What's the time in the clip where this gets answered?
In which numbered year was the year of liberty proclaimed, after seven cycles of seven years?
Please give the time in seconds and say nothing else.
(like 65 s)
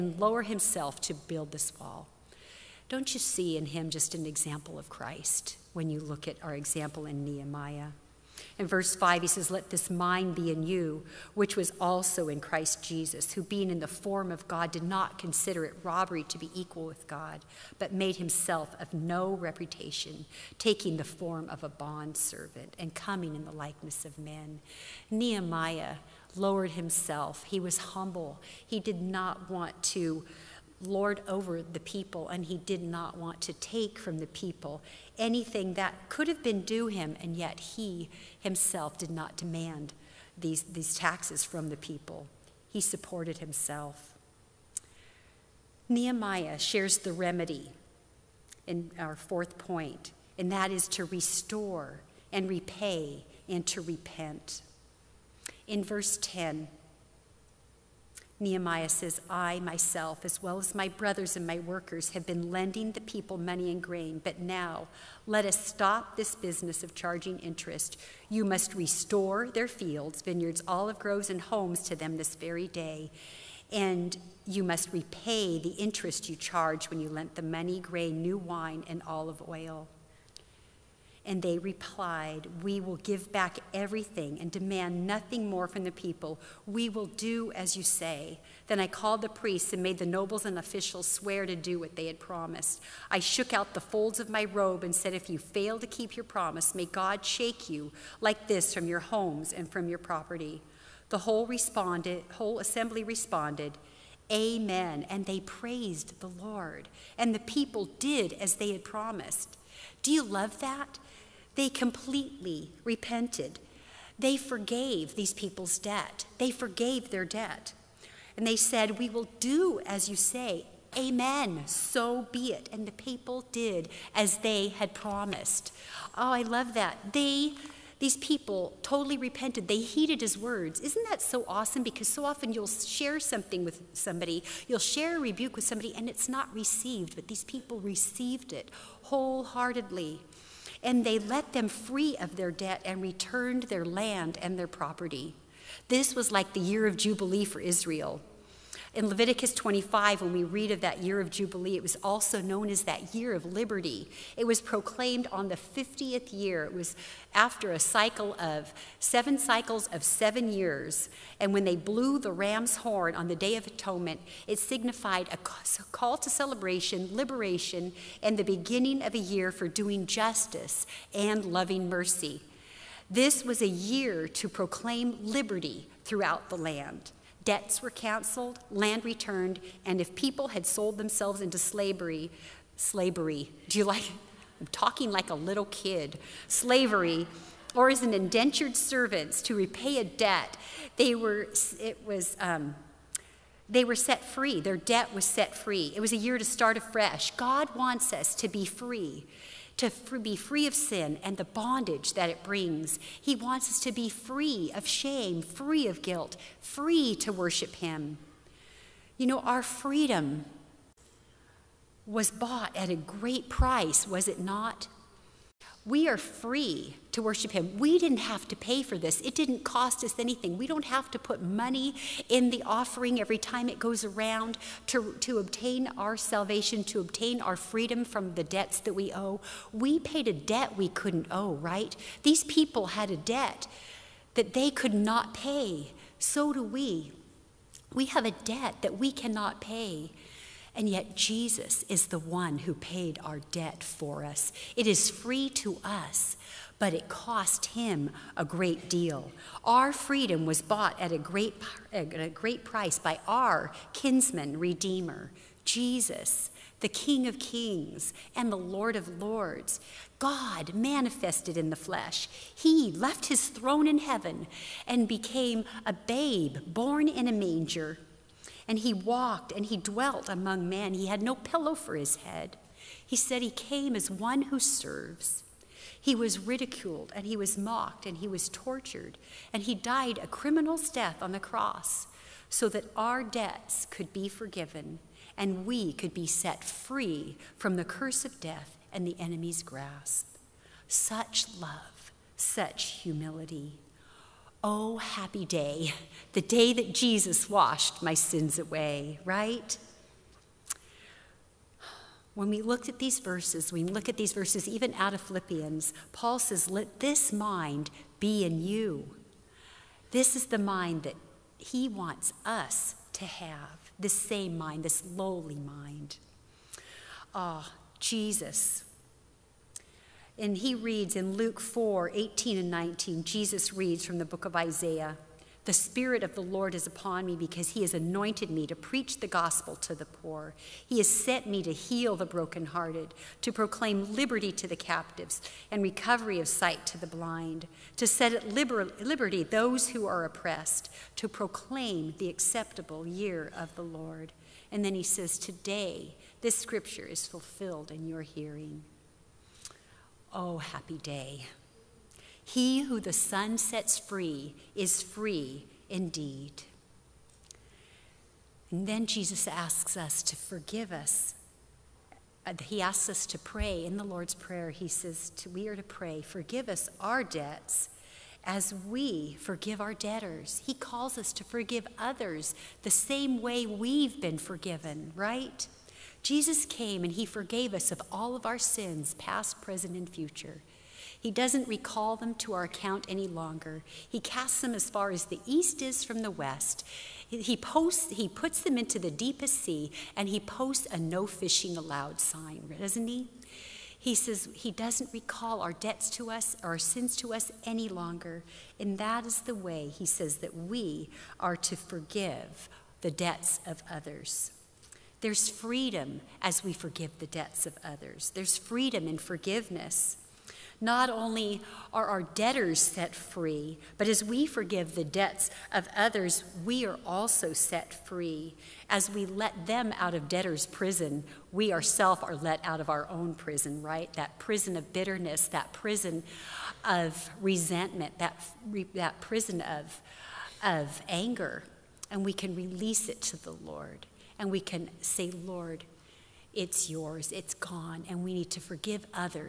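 155 s.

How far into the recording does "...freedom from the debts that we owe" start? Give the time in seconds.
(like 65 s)
227 s.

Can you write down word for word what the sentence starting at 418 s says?
As we let them out of debtors' prison, we ourselves are let out of our own prison, right?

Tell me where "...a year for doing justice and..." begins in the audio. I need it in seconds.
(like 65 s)
169 s.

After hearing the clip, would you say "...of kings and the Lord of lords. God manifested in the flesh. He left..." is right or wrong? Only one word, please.
right.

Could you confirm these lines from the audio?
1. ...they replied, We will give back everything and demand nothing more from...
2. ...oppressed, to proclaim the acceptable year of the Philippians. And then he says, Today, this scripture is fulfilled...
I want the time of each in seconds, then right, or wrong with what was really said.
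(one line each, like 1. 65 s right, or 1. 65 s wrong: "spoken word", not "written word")
1. 81 s right
2. 340 s wrong: "Lord", not "Philippians".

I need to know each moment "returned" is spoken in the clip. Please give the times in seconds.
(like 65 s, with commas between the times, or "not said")
143 s, 179 s.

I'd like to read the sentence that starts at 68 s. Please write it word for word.
You must restore their fields, vineyards, olive groves, and homes to them this very day.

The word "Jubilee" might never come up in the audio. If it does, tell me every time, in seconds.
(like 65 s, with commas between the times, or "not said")
146 s, 151 s.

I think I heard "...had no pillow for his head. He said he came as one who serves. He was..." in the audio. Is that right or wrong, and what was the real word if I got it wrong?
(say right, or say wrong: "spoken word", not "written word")
right.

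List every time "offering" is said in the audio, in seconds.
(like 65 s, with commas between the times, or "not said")
222 s.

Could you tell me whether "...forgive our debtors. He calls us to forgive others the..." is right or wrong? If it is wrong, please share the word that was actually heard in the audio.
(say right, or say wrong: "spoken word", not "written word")
right.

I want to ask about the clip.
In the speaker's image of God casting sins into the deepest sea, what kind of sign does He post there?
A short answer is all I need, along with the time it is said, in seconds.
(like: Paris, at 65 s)
no fishing allowed, at 390 s.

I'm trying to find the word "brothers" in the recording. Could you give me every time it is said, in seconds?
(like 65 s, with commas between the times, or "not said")
60 s.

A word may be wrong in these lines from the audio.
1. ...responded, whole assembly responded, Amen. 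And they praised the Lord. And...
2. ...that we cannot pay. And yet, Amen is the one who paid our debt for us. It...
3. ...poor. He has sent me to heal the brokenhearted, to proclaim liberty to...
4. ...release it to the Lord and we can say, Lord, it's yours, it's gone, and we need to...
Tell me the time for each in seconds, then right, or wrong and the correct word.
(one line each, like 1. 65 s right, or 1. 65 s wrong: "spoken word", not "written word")
1. 101 s right
2. 238 s wrong: "Jesus", not "Amen"
3. 330 s right
4. 432 s right.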